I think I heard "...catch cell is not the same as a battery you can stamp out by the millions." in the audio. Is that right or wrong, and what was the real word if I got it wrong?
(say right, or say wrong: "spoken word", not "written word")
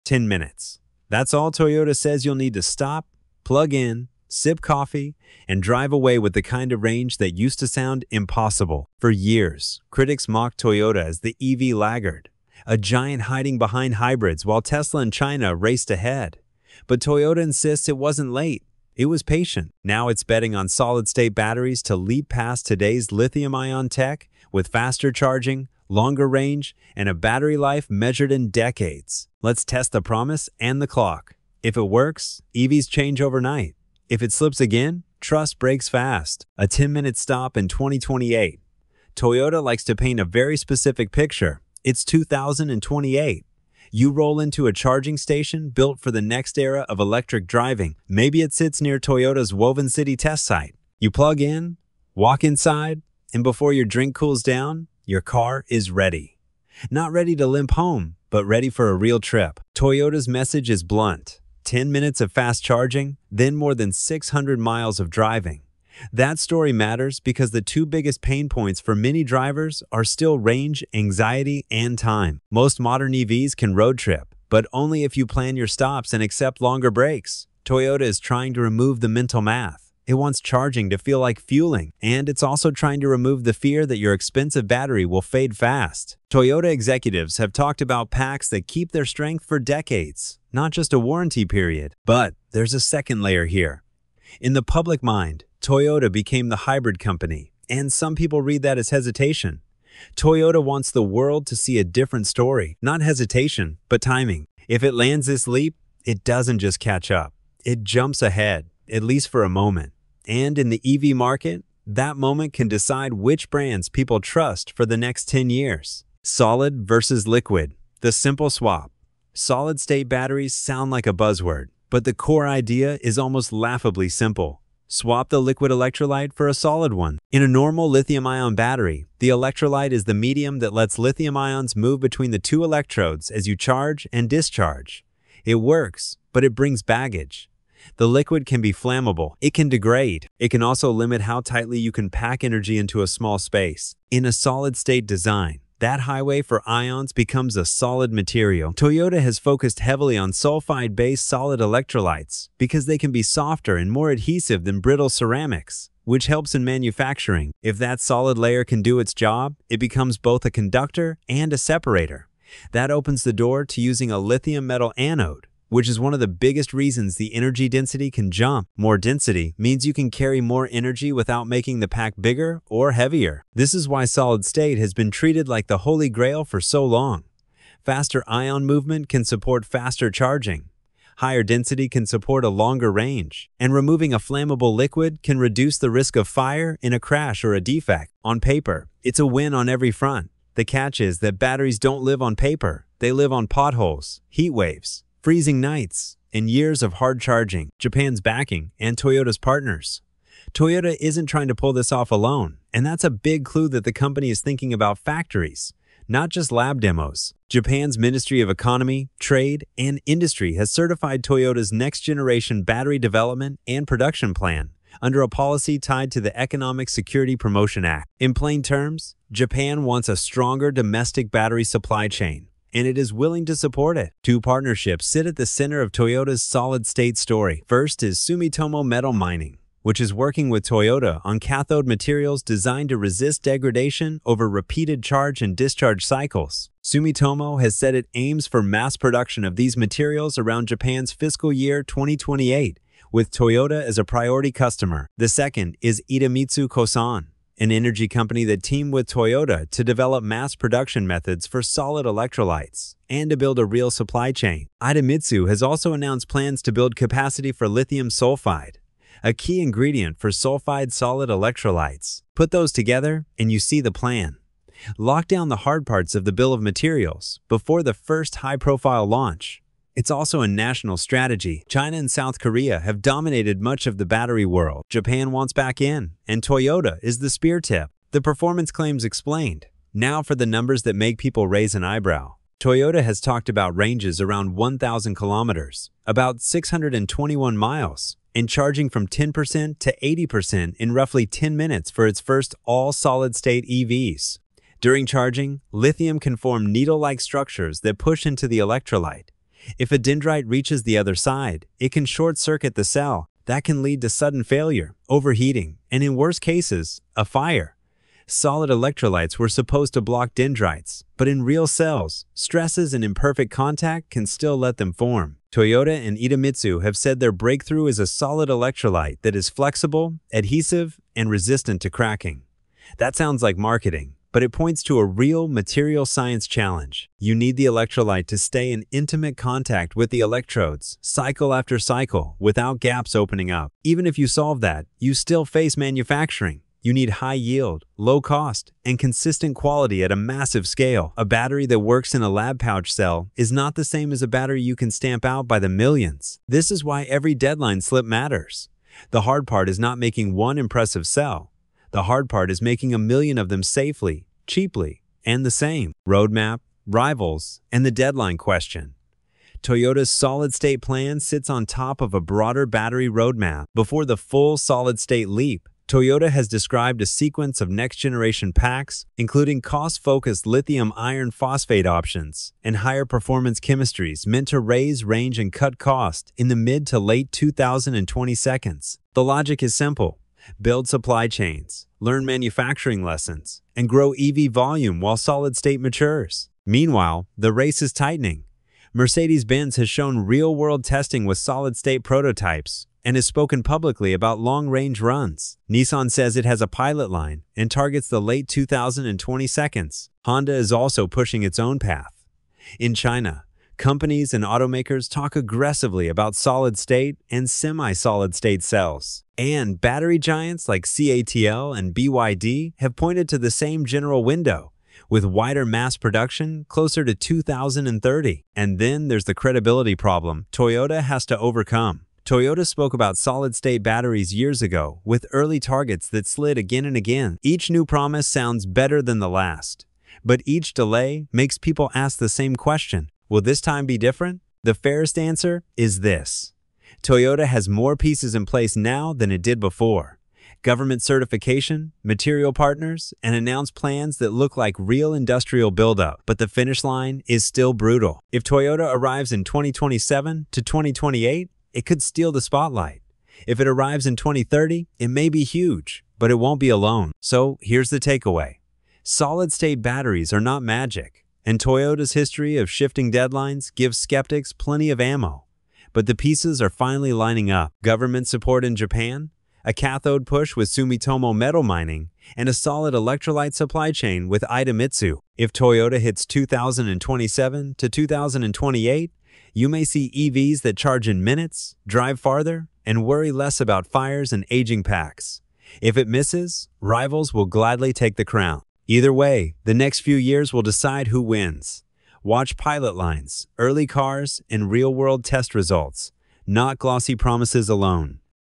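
wrong: "pouch", not "catch".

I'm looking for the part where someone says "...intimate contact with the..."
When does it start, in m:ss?
5:28.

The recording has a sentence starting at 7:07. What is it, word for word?
Each new promise sounds better than the last, but each delay makes people ask the same question.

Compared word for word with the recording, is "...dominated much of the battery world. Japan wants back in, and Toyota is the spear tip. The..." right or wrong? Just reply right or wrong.
right.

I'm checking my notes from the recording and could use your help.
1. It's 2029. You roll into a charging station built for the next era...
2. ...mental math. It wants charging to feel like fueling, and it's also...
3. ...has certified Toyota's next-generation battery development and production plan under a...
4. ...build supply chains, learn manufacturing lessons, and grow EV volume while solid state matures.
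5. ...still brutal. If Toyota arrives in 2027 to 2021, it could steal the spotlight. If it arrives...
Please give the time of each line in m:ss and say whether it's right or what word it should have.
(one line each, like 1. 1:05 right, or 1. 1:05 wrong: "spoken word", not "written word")
1. 0:41 wrong: "2028", not "2029"
2. 1:19 right
3. 3:30 right
4. 6:20 right
5. 7:27 wrong: "2028", not "2021".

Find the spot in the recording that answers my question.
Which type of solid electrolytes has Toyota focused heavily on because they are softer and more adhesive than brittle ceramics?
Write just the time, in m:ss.
2:30.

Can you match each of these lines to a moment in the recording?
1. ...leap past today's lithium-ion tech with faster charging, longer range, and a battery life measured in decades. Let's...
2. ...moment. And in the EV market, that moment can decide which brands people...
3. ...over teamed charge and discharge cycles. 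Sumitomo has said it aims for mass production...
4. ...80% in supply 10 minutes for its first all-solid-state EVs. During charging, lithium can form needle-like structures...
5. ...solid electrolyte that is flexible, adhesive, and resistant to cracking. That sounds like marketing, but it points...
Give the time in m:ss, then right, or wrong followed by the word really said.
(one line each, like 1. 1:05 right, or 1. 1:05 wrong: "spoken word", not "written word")
1. 0:21 right
2. 1:49 right
3. 3:54 wrong: "repeated", not "teamed"
4. 4:50 wrong: "roughly", not "supply"
5. 5:18 right.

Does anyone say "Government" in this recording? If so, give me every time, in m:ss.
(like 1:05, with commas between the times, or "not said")
7:20, 7:47.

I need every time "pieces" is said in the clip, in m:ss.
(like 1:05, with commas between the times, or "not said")
7:17, 7:46.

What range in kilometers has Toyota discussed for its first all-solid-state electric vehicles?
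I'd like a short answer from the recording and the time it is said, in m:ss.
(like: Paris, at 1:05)
1,000 kilometers, at 4:44.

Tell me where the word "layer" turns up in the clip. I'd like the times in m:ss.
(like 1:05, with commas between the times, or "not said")
1:33, 2:38.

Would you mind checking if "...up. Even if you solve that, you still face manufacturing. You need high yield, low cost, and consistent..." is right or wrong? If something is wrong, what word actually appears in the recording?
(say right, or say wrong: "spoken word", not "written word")
right.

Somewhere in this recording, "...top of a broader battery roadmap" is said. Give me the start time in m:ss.
6:01.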